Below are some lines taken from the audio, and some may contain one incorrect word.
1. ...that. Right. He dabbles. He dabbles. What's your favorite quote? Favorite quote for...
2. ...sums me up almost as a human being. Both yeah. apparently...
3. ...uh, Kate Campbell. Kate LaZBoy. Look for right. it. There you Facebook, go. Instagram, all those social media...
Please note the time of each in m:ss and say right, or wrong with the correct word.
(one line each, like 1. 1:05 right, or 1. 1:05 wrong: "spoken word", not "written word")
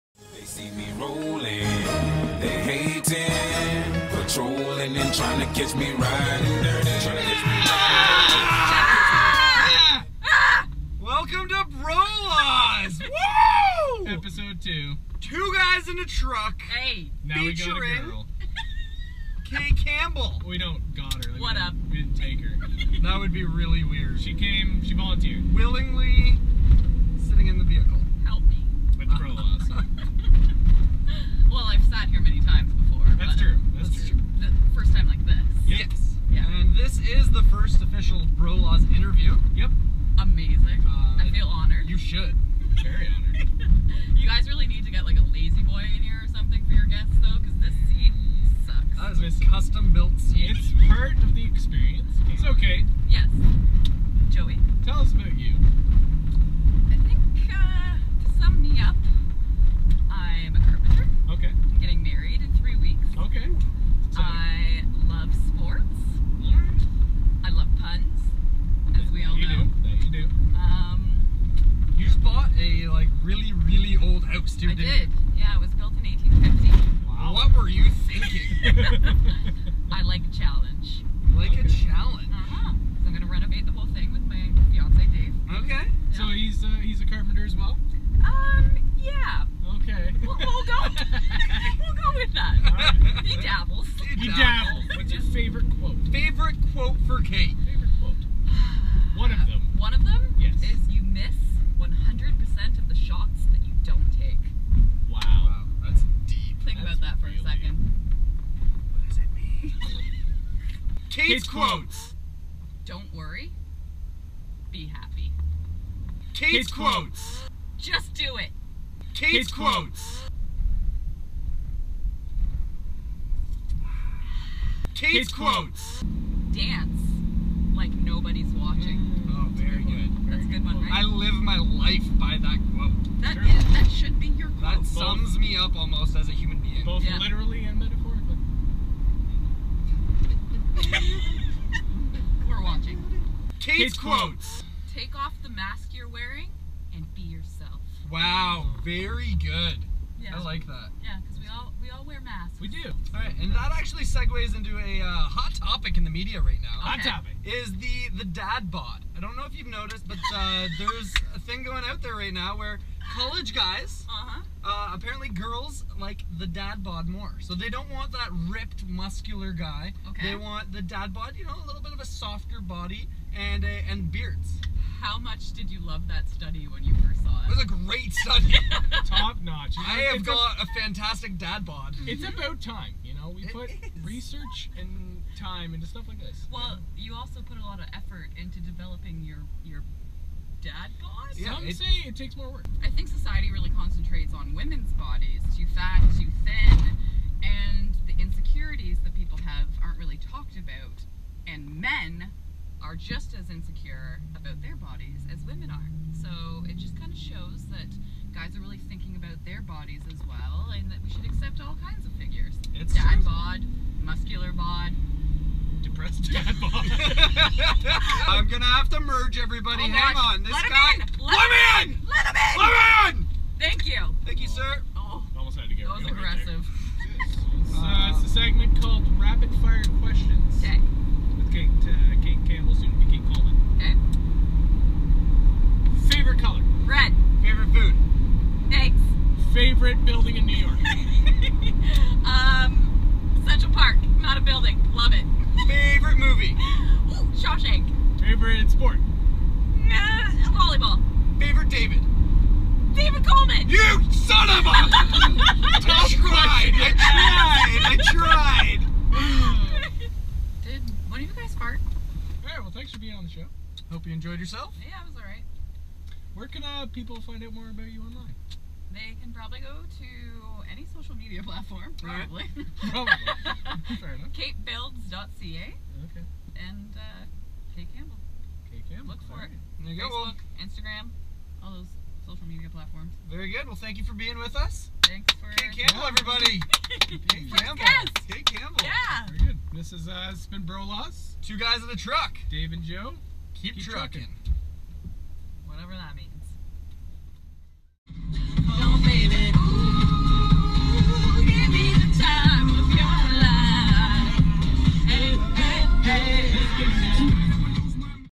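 1. 1:32 right
2. 2:14 wrong: "literally", not "apparently"
3. 4:36 wrong: "Campbell", not "LaZBoy".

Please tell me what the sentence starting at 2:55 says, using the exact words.
How much did you love that study when you first saw it?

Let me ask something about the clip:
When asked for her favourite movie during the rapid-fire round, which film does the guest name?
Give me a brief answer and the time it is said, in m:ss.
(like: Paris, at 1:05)
Shawshank, at 4:07.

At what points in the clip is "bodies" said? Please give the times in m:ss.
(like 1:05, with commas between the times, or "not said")
3:15, 3:24, 3:29.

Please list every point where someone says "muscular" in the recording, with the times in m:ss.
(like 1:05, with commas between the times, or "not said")
2:48, 3:34.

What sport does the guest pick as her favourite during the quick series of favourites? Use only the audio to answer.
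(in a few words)
Volleyball.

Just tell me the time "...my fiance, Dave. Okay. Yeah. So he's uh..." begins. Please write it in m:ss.
1:24.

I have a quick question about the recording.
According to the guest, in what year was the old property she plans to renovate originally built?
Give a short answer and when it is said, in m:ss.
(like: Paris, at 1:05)
1850, at 1:16.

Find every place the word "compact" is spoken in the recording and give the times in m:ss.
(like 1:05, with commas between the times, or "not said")
not said.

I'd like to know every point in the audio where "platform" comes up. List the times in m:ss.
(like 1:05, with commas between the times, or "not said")
4:31, 4:42.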